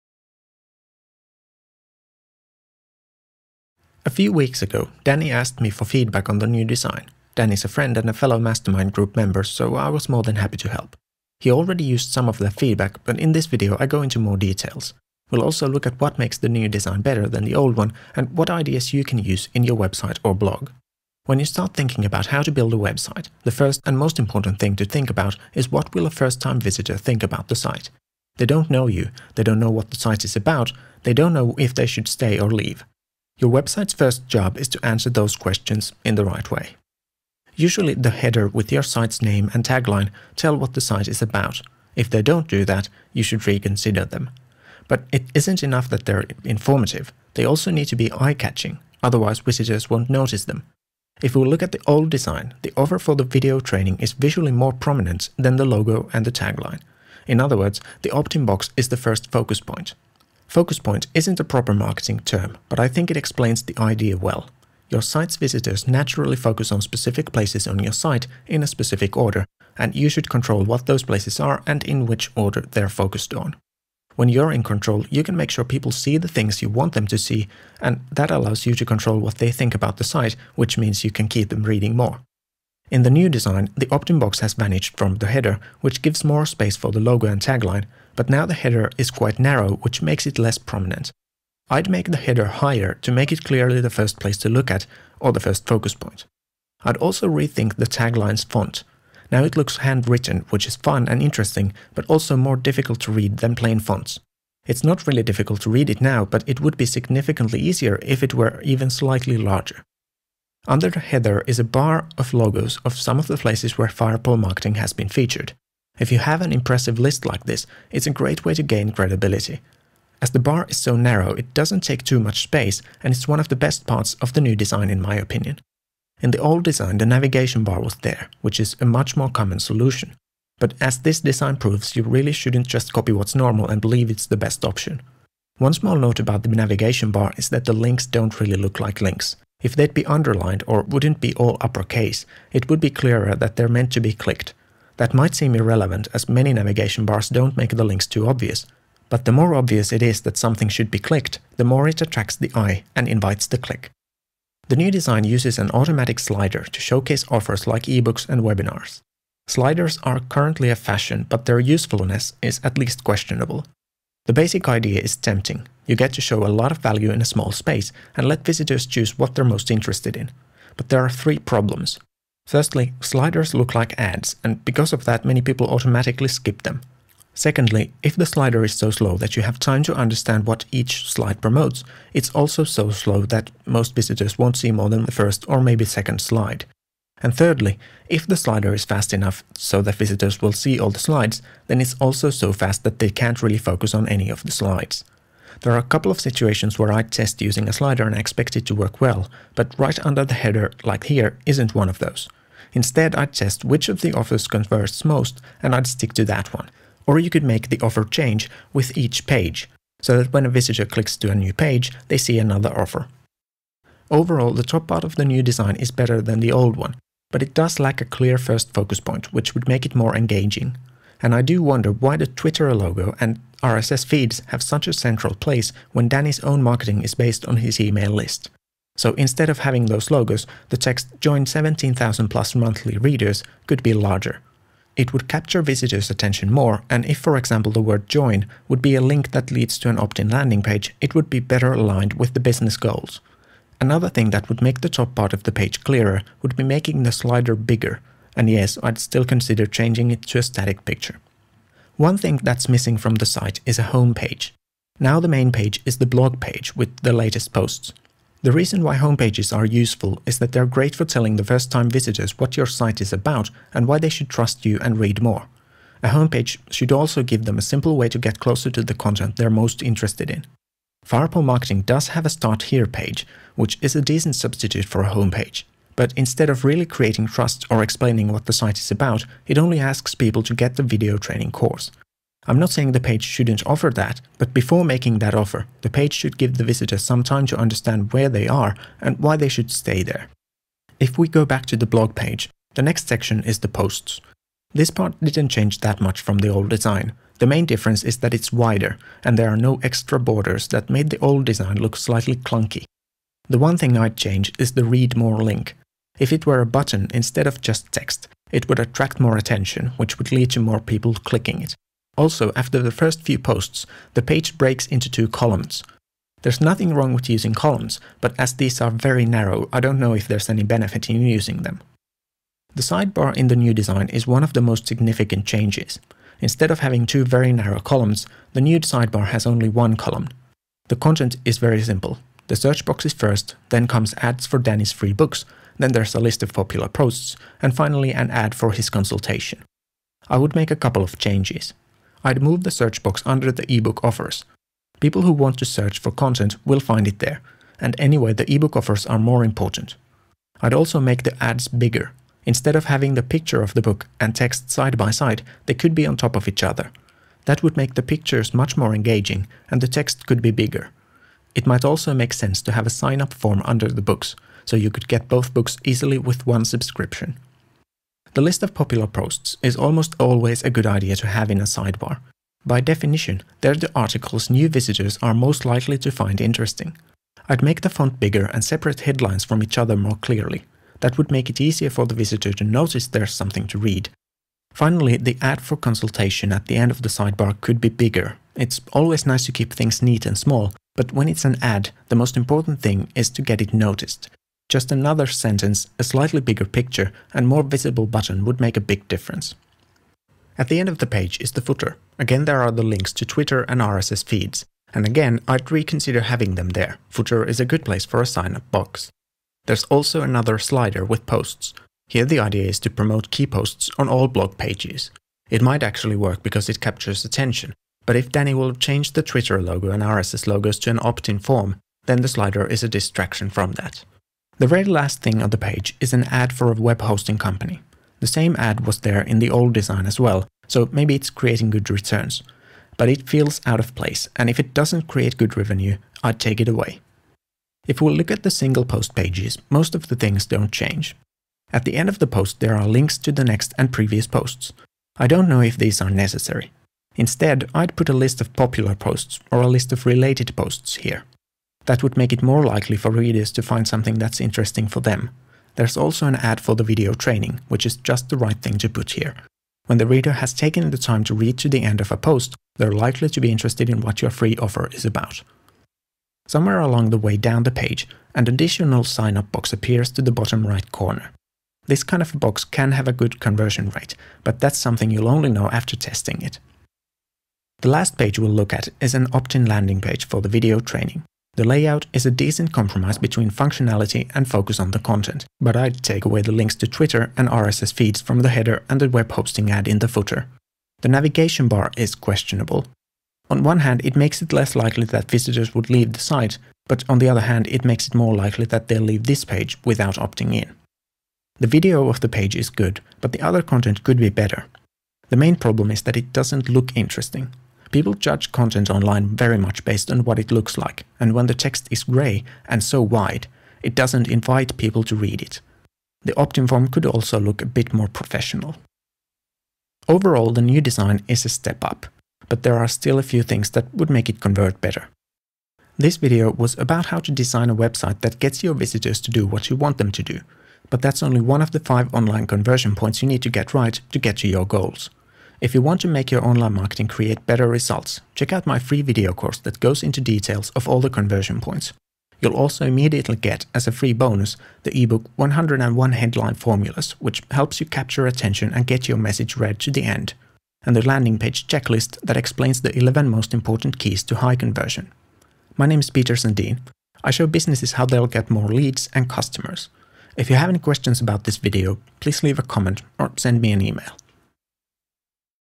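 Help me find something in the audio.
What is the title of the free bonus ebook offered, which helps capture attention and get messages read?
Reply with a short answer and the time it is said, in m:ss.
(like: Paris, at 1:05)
101 Headline Formulas, at 9:05.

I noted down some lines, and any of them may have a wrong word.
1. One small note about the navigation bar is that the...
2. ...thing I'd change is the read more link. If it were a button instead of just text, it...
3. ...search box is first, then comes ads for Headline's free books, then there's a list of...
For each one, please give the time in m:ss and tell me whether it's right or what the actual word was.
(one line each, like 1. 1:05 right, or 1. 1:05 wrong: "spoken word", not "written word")
1. 2:15 right
2. 5:03 right
3. 5:32 wrong: "Danny", not "Headline".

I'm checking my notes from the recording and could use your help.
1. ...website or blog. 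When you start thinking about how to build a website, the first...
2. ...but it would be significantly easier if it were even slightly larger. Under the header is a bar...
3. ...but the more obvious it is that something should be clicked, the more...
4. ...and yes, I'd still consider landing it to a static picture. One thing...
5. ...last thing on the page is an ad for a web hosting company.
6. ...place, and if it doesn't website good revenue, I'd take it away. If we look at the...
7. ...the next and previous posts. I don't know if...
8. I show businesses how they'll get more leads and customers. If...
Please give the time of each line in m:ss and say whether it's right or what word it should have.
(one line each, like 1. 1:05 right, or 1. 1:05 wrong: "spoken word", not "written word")
1. 0:19 right
2. 1:46 right
3. 2:29 right
4. 4:08 wrong: "changing", not "landing"
5. 7:04 right
6. 7:13 wrong: "create", not "website"
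7. 7:23 right
8. 9:17 right.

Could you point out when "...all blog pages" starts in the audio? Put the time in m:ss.
6:54.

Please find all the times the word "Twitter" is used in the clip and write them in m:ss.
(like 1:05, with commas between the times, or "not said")
3:42, 6:43, 6:59, 8:06.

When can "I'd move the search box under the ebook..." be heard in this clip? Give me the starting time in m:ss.
5:42.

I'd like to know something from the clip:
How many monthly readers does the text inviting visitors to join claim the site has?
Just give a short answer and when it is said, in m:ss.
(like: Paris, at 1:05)
17,000, at 3:51.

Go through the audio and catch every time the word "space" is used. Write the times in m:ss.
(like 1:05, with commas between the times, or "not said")
1:26, 2:02, 2:47.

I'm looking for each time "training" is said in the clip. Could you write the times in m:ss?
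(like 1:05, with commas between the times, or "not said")
0:53, 4:41, 7:37, 8:00.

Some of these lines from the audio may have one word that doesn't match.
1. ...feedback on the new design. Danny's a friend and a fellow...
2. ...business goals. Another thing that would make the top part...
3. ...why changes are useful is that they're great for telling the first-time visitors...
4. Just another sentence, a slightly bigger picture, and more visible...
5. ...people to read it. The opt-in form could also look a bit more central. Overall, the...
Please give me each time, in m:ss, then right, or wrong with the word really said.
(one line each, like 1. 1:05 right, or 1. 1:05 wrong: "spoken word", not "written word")
1. 0:05 right
2. 4:02 right
3. 4:18 wrong: "homepages", not "changes"
4. 6:34 right
5. 8:34 wrong: "professional", not "central".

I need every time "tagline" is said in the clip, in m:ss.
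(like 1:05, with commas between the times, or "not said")
0:39, 0:56, 1:27, 1:37.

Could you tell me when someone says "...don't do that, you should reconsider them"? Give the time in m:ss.
0:42.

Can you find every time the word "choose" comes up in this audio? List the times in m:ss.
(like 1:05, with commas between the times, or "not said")
2:48.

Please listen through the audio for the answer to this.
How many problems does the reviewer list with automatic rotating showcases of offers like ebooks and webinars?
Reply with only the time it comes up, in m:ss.
2:51.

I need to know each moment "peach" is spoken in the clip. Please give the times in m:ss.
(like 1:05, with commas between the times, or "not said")
not said.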